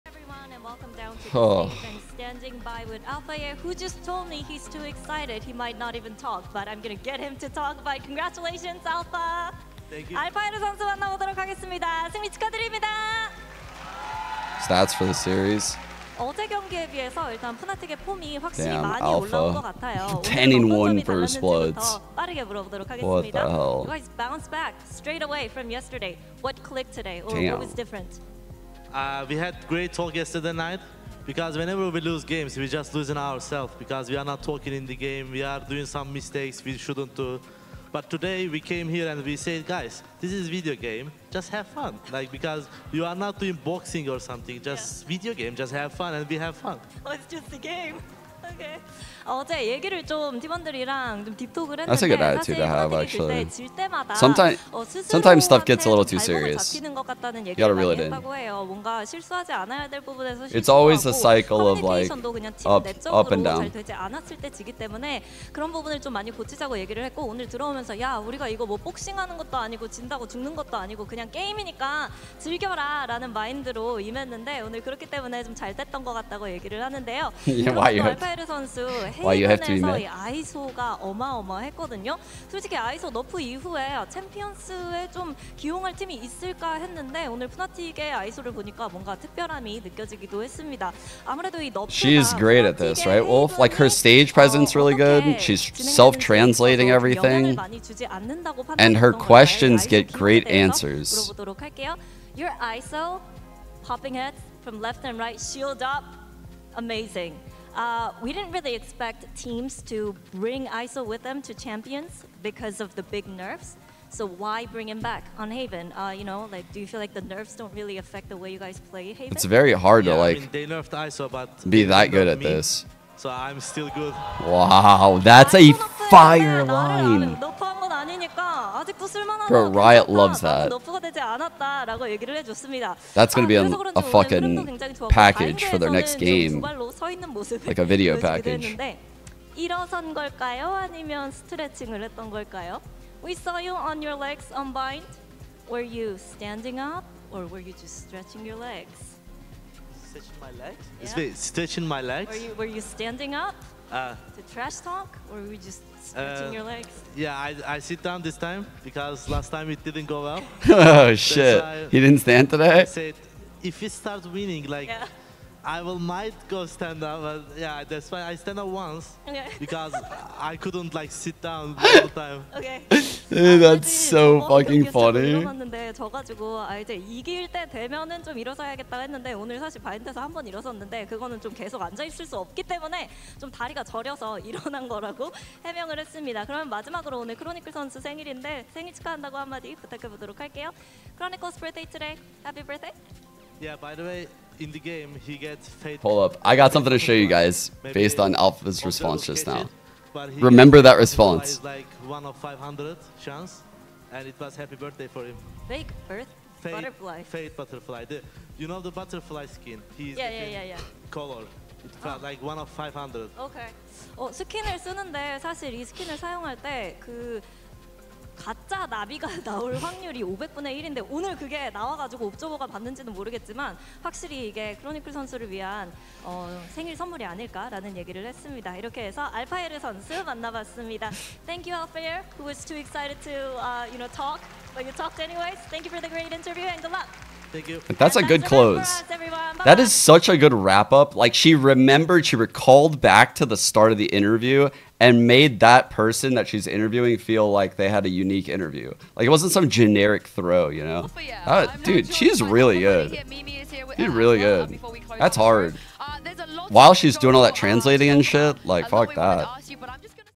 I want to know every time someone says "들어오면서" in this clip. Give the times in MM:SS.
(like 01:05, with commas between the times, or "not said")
01:07.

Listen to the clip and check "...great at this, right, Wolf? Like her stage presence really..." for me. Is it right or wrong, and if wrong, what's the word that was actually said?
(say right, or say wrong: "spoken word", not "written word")
right.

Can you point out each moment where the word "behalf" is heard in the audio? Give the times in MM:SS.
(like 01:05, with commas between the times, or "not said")
not said.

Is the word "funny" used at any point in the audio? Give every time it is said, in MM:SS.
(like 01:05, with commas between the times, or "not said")
02:54.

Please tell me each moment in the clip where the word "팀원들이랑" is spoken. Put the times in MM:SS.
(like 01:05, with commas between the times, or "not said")
00:50.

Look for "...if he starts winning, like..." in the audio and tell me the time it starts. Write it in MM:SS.
02:43.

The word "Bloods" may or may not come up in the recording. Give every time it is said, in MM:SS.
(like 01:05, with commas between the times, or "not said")
00:21.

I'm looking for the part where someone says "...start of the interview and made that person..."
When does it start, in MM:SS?
04:03.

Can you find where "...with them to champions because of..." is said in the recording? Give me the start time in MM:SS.
01:51.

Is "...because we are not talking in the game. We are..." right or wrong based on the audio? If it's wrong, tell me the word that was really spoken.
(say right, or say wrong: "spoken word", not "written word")
right.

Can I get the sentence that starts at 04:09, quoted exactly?
Like it wasn't some generic throw, you know?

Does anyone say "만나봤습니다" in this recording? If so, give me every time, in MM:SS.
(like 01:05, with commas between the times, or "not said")
03:50.